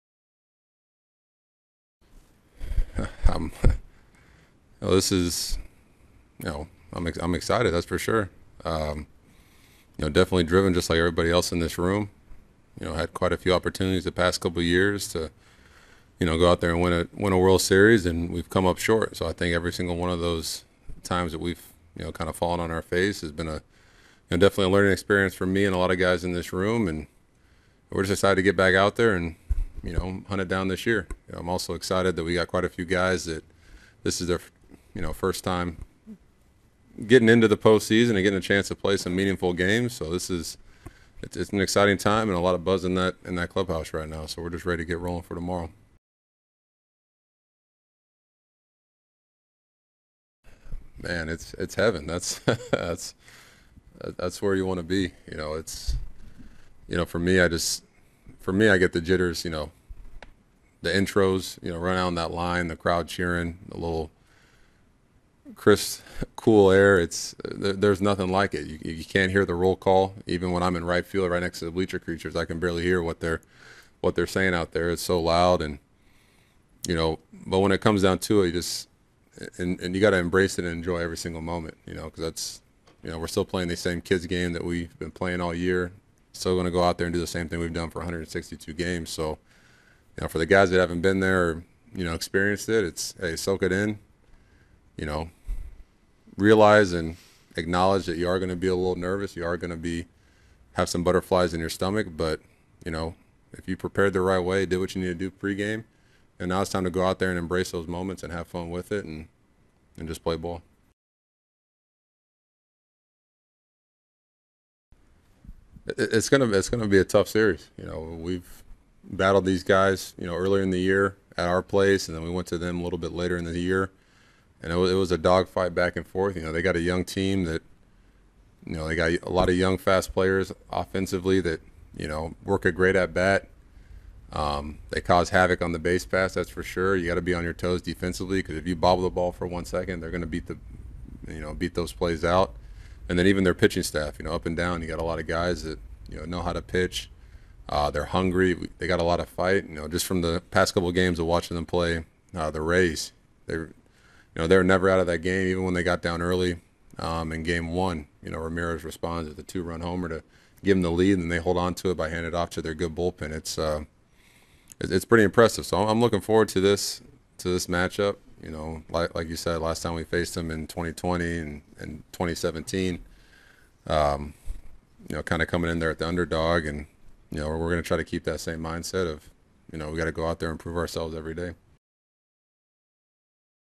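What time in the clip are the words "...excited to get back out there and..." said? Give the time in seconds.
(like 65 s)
28 s.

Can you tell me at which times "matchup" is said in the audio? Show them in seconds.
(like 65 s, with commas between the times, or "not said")
167 s.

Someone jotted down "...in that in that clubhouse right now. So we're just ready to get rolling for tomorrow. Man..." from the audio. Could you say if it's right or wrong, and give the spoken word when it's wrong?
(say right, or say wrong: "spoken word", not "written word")
right.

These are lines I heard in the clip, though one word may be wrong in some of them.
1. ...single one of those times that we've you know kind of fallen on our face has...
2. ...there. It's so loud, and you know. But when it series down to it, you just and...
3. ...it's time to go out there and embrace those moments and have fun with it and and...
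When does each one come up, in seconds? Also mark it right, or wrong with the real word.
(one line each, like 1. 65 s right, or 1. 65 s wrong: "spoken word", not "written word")
1. 19 s right
2. 74 s wrong: "comes", not "series"
3. 106 s right.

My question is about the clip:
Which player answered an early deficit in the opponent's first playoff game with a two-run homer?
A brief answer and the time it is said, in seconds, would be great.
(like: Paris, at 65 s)
Ramirez, at 158 s.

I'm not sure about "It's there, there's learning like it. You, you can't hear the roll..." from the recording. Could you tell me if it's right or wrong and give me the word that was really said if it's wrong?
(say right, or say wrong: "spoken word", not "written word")
wrong: "nothing", not "learning".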